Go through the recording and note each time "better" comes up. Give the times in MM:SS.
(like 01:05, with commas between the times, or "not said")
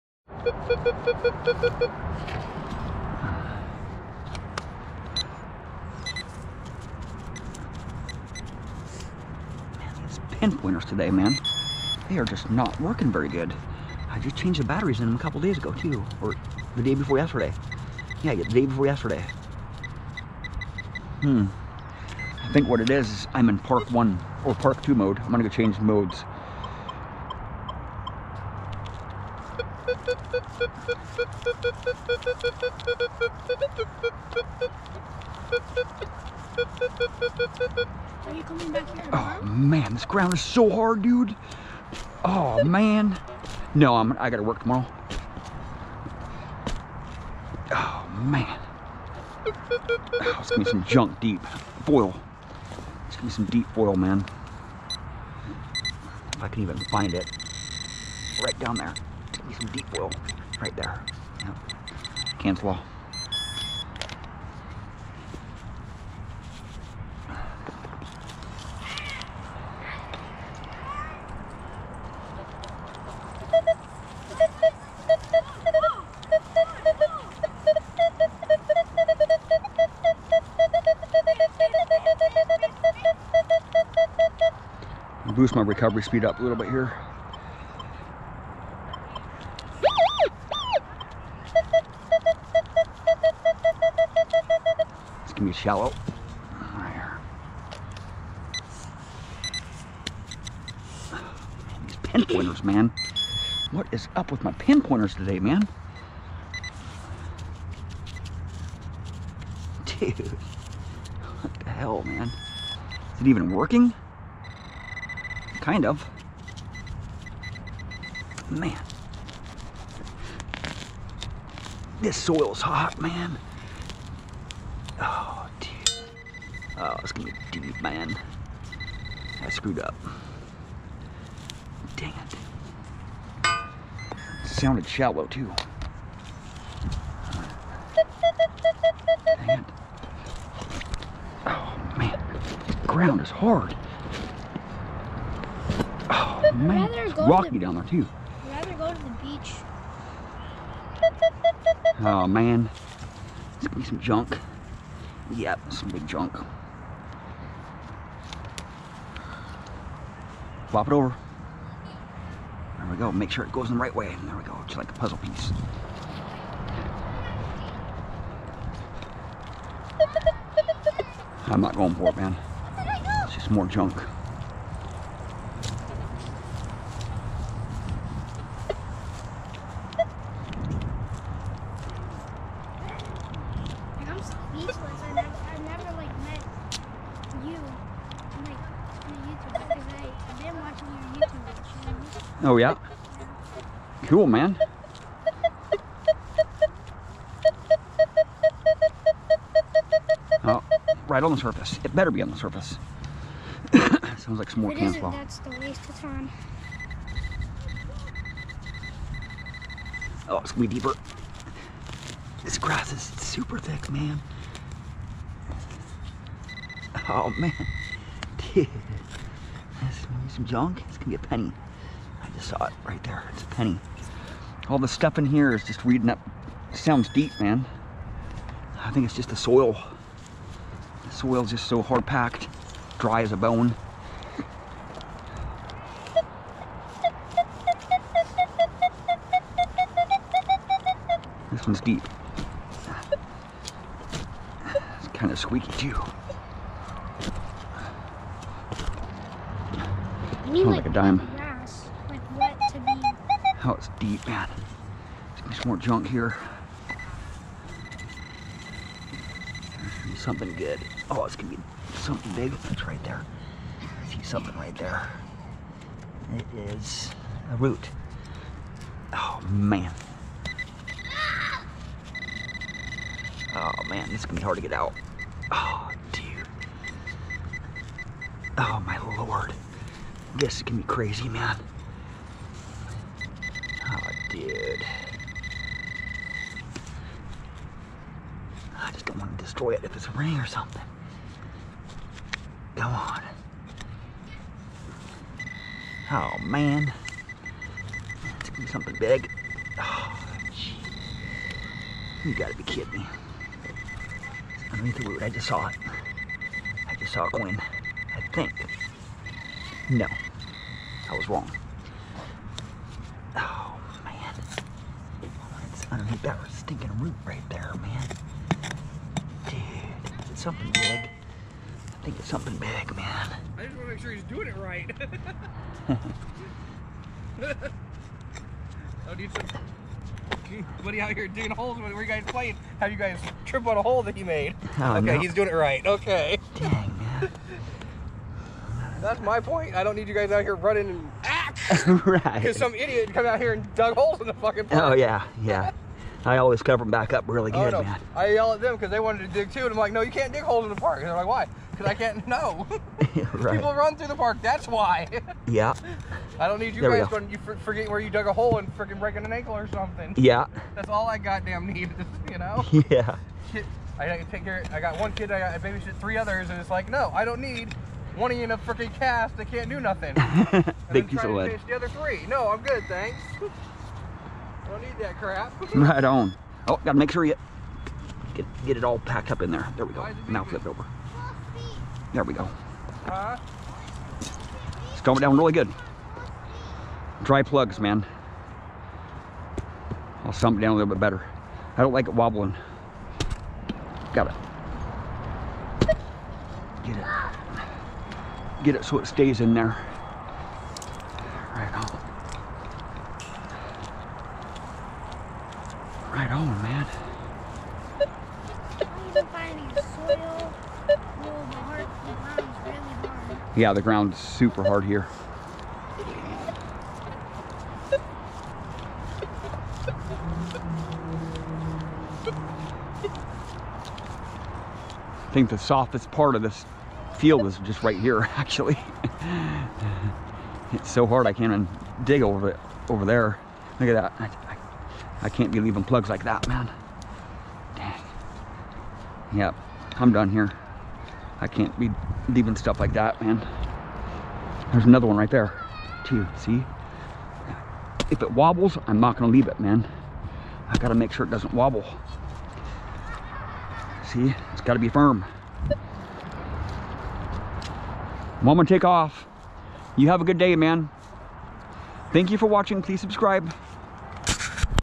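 03:21, 06:31.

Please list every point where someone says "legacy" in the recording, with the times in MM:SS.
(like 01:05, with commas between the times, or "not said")
not said.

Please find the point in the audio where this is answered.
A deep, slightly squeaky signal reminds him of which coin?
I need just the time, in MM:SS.
04:10.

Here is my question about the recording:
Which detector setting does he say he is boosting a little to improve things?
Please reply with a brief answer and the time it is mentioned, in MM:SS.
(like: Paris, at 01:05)
recovery speed, at 01:25.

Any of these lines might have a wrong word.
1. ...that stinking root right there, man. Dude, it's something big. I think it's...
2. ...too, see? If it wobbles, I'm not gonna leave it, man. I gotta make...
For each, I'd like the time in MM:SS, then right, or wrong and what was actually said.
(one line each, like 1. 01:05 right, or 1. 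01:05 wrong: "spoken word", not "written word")
1. 05:16 right
2. 07:26 right.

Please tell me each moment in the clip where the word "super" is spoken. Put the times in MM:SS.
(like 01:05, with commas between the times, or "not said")
03:33, 06:54.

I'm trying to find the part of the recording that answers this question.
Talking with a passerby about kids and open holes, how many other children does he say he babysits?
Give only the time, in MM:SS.
06:05.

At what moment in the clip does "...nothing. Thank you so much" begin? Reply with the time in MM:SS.
06:09.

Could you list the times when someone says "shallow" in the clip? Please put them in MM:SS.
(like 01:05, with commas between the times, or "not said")
01:35, 02:14.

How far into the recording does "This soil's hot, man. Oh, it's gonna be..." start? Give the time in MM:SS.
02:02.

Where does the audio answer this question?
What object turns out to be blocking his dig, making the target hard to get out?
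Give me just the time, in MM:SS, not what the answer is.
04:26.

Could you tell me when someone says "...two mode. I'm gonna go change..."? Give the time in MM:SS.
00:24.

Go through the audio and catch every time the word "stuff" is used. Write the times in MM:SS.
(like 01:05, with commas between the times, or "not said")
03:44, 07:22.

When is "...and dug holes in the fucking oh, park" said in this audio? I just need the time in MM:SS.
05:43.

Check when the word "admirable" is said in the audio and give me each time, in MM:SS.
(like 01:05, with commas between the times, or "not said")
not said.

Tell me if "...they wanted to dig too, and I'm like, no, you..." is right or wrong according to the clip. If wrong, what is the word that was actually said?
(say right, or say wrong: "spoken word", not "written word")
right.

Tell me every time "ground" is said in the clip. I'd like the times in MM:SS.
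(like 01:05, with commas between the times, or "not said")
00:40, 02:22, 06:53.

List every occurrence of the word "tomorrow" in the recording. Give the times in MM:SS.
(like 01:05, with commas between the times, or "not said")
00:44.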